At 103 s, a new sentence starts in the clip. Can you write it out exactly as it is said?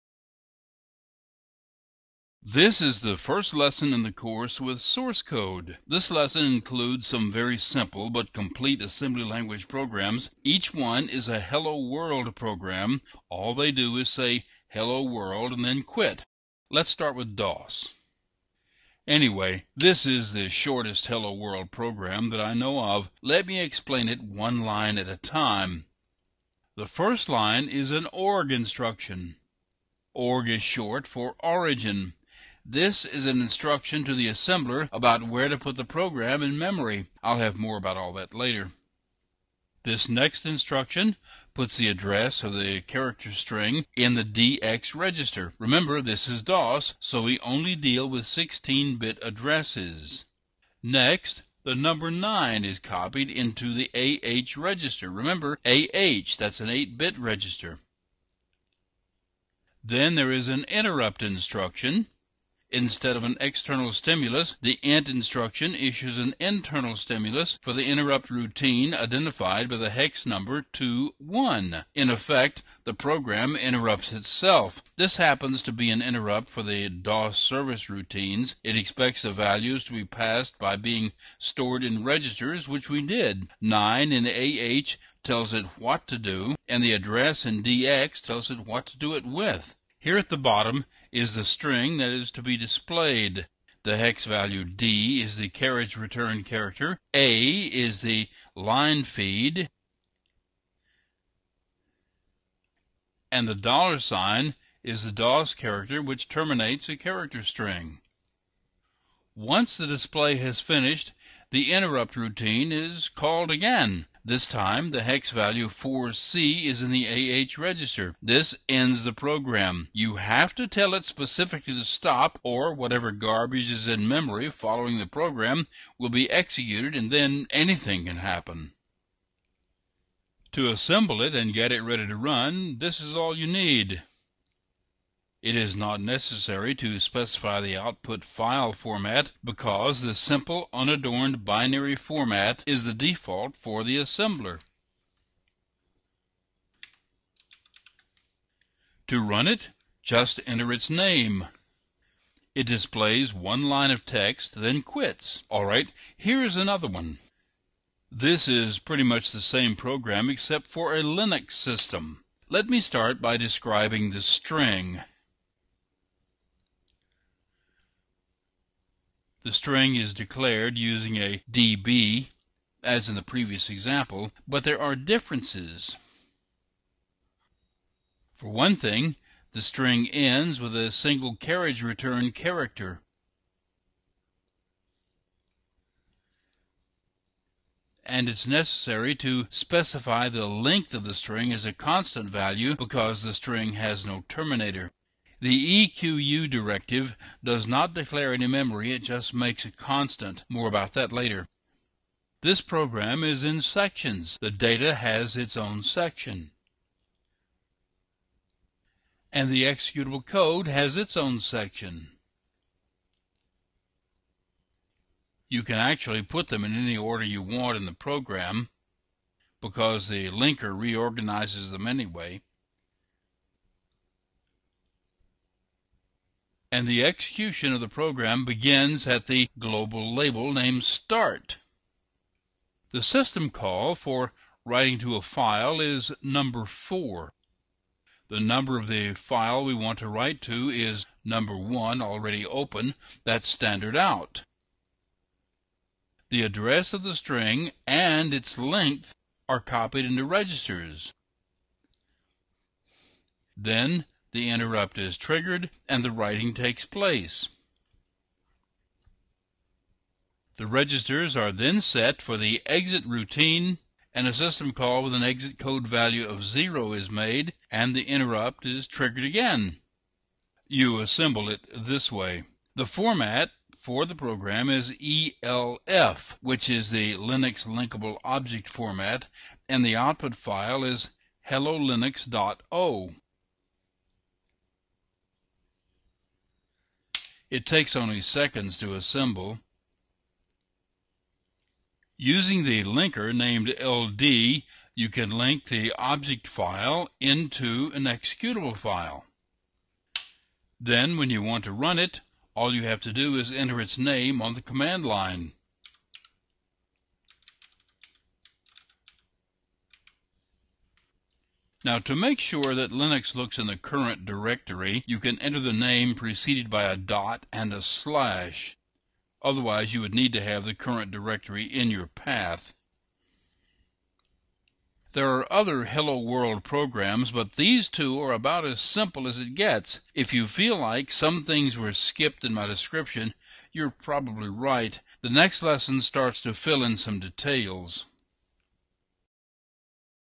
And the dollar sign is the DOS character which terminates a character string.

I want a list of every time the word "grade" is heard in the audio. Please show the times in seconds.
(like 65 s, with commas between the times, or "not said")
not said.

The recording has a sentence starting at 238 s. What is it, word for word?
The number of the file we want to write to is number 1 already open, that's standard out.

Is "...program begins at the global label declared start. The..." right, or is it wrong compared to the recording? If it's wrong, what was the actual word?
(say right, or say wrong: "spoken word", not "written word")
wrong: "named", not "declared".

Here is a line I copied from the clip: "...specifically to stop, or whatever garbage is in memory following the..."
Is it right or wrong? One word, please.
right.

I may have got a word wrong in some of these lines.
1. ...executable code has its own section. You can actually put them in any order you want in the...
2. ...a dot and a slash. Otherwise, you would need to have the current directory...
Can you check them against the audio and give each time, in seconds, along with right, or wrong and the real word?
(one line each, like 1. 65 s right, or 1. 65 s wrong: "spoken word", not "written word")
1. 209 s right
2. 316 s right.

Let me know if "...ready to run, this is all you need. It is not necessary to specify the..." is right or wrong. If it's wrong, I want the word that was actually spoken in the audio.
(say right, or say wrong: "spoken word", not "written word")
right.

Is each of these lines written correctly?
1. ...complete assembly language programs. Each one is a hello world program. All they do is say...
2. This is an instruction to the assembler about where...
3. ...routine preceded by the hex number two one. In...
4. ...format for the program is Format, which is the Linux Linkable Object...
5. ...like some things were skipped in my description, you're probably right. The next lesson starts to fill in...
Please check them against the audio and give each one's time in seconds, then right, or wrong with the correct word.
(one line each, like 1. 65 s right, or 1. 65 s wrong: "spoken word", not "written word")
1. 8 s right
2. 32 s right
3. 68 s wrong: "identified", not "preceded"
4. 272 s wrong: "ELF", not "Format"
5. 330 s right.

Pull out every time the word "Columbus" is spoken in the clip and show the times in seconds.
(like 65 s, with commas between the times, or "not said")
not said.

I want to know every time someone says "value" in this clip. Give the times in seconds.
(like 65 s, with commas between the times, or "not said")
79 s, 94 s, 115 s, 192 s, 265 s.